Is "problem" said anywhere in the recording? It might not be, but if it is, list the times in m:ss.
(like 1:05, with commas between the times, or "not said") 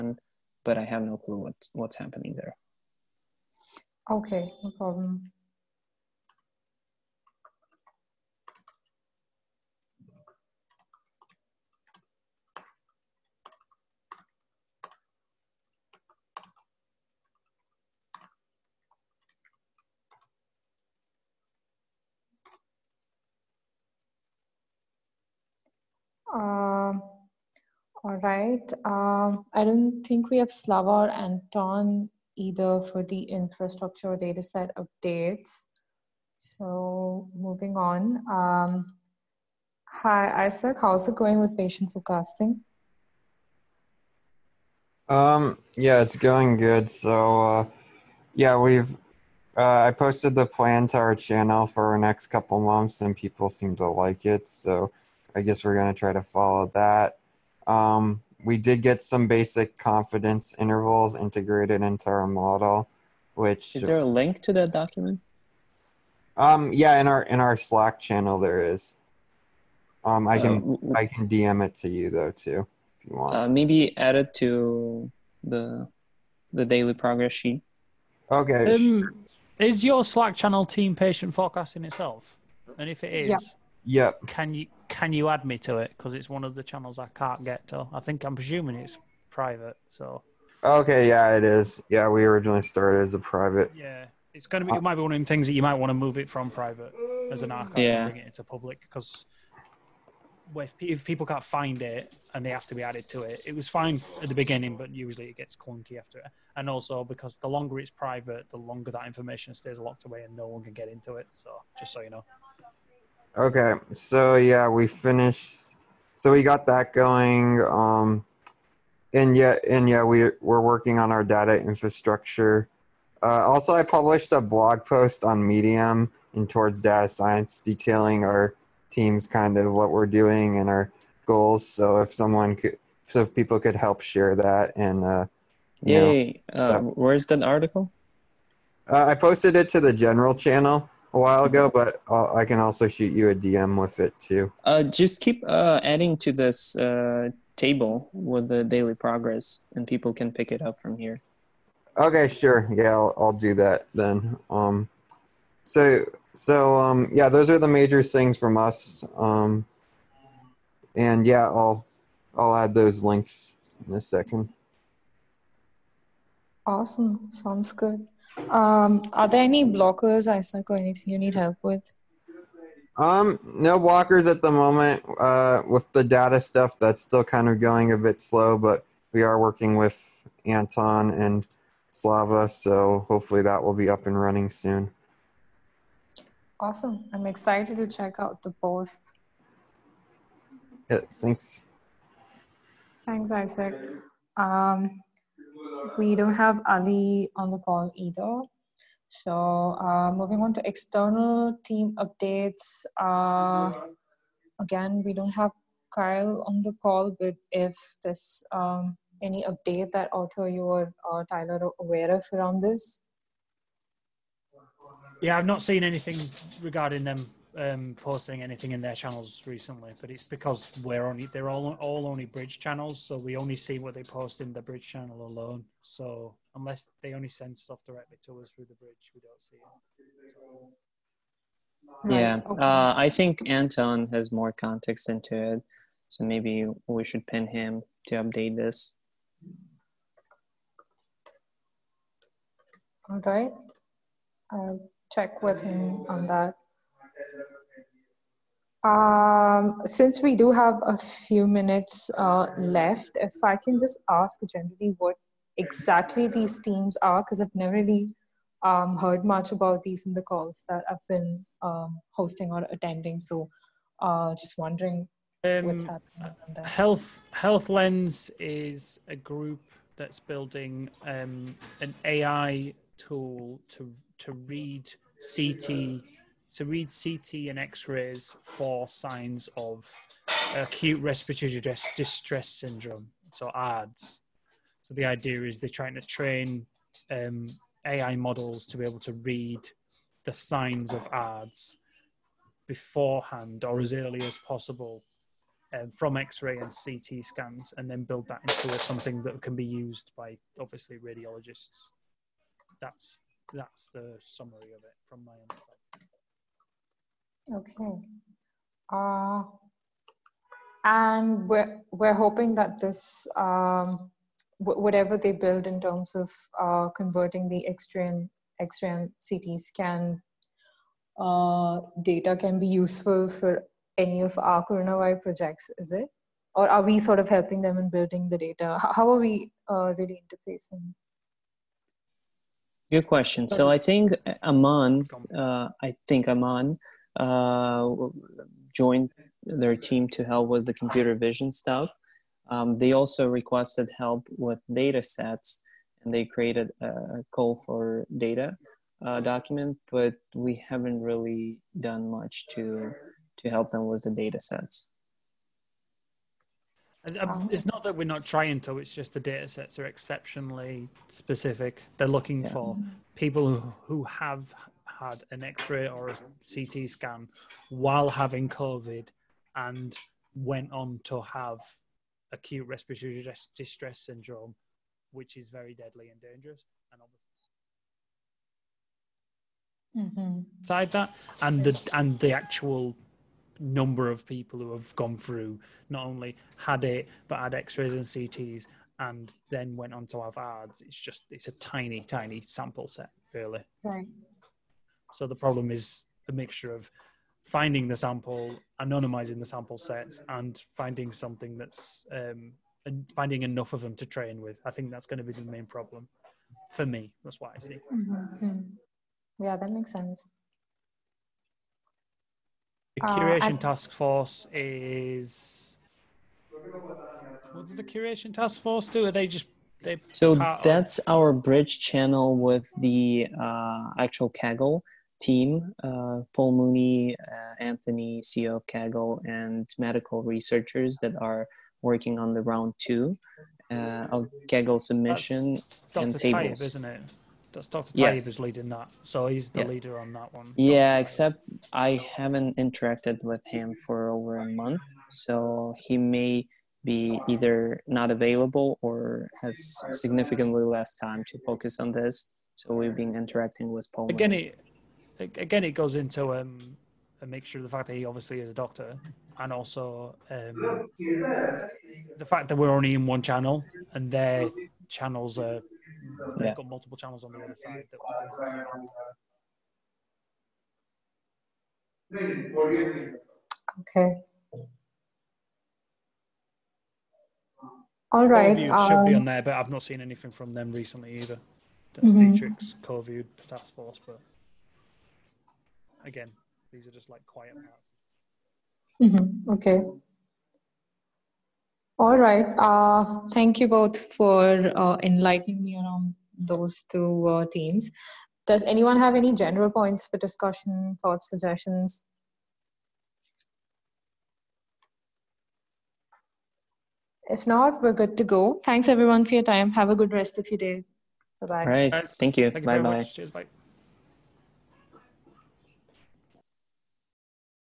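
0:04, 6:35, 6:45.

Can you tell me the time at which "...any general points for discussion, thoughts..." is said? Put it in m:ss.
8:19.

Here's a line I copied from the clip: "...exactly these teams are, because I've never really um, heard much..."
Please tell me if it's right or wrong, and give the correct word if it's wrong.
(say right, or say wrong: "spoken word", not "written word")
right.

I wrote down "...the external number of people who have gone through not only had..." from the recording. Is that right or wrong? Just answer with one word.
wrong.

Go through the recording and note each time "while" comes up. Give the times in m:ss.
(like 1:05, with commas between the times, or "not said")
2:21, 6:07.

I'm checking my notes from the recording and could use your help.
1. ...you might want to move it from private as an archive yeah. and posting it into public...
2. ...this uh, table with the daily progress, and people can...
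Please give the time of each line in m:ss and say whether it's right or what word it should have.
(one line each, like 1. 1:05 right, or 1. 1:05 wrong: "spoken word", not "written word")
1. 1:35 wrong: "bring", not "posting"
2. 2:26 right.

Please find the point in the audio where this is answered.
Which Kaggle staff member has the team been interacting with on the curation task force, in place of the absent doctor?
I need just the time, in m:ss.
7:06.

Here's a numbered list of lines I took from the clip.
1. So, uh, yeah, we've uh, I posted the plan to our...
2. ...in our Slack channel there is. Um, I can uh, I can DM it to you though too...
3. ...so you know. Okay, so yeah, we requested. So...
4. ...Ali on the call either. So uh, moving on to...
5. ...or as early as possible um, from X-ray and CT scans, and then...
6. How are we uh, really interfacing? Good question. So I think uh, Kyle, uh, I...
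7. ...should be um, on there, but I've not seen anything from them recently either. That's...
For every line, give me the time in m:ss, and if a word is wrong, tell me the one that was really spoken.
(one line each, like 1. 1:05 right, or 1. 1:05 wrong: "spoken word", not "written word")
1. 0:46 right
2. 1:07 right
3. 1:51 wrong: "finished", not "requested"
4. 3:16 right
5. 4:53 right
6. 5:28 wrong: "Aman", not "Kyle"
7. 7:58 right.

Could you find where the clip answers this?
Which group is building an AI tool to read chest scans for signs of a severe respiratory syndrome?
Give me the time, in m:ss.
4:27.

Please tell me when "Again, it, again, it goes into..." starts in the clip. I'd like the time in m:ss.
7:34.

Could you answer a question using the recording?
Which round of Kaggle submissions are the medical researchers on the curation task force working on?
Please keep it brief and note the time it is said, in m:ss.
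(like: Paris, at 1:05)
Round two, at 7:12.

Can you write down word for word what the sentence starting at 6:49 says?
yeah that makes sense the uh, curation uh, task force is.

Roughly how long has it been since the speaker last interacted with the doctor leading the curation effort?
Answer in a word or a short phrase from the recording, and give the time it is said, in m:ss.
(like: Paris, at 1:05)
Over a month, at 7:24.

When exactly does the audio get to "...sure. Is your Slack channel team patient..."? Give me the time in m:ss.
1:19.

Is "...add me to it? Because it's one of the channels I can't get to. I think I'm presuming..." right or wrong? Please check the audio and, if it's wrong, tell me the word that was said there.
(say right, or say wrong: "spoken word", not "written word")
right.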